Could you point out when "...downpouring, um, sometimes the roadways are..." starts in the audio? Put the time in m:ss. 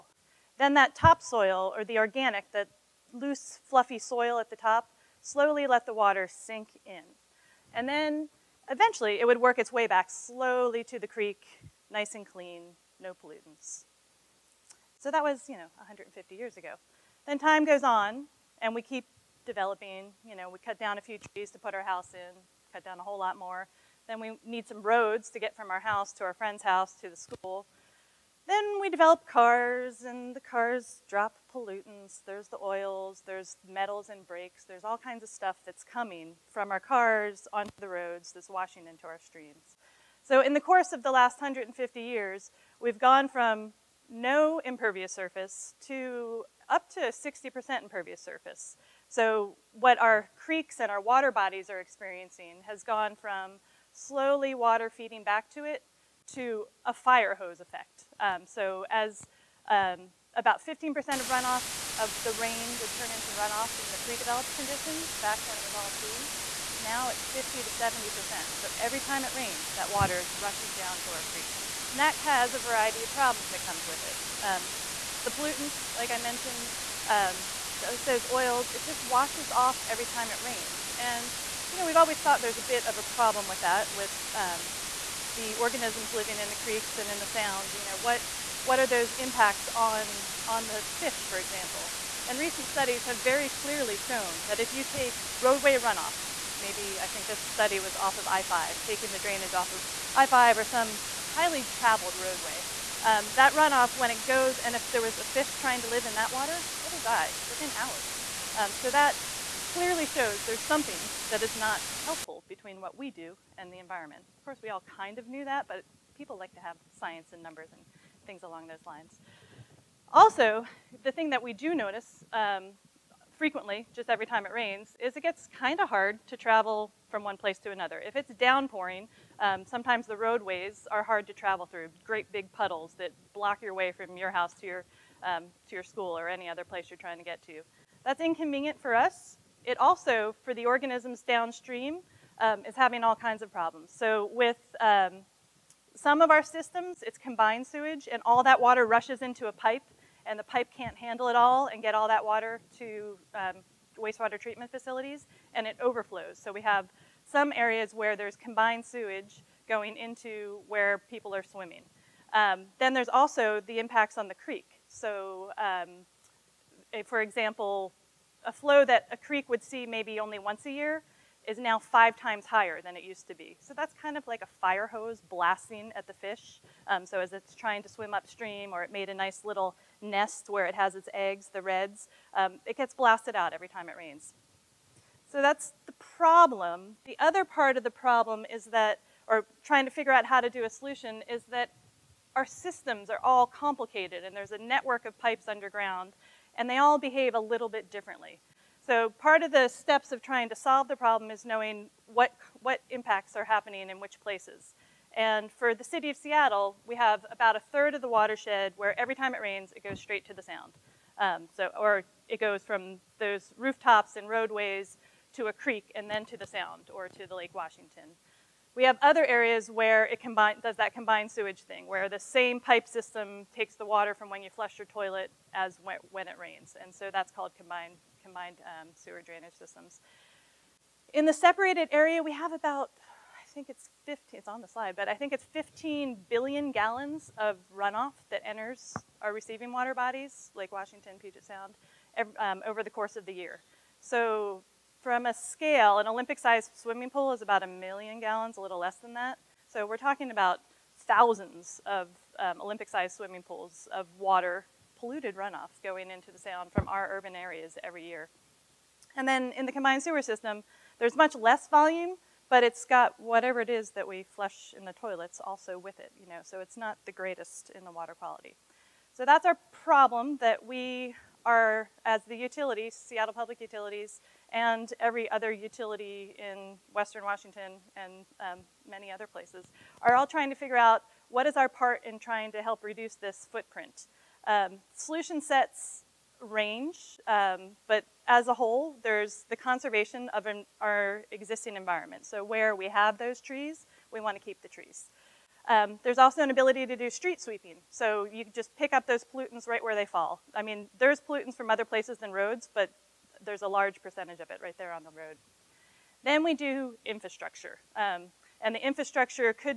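2:08.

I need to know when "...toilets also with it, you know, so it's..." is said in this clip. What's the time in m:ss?
4:24.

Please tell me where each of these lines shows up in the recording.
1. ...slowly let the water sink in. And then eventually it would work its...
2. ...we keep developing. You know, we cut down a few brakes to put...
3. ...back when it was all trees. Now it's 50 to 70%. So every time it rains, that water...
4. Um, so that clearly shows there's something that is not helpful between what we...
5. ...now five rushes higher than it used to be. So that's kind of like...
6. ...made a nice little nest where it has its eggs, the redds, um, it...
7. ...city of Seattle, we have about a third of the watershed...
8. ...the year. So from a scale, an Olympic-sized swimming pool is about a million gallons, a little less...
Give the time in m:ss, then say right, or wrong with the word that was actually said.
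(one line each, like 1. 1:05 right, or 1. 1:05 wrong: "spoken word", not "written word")
1. 0:05 right
2. 0:18 wrong: "trees", not "brakes"
3. 1:05 right
4. 1:48 right
5. 2:51 wrong: "times", not "rushes"
6. 2:58 right
7. 3:25 right
8. 4:03 right.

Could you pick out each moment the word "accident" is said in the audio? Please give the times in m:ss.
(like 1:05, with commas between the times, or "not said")
not said.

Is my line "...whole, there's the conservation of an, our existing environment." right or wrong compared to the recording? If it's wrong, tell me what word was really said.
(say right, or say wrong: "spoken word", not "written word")
right.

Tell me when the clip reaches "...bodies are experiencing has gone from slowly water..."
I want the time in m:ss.
0:51.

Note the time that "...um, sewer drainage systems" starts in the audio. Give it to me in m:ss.
3:48.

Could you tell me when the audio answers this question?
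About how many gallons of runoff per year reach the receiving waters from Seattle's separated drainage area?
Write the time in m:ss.
3:55.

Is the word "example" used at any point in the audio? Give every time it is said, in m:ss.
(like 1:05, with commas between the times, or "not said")
1:31, 2:47.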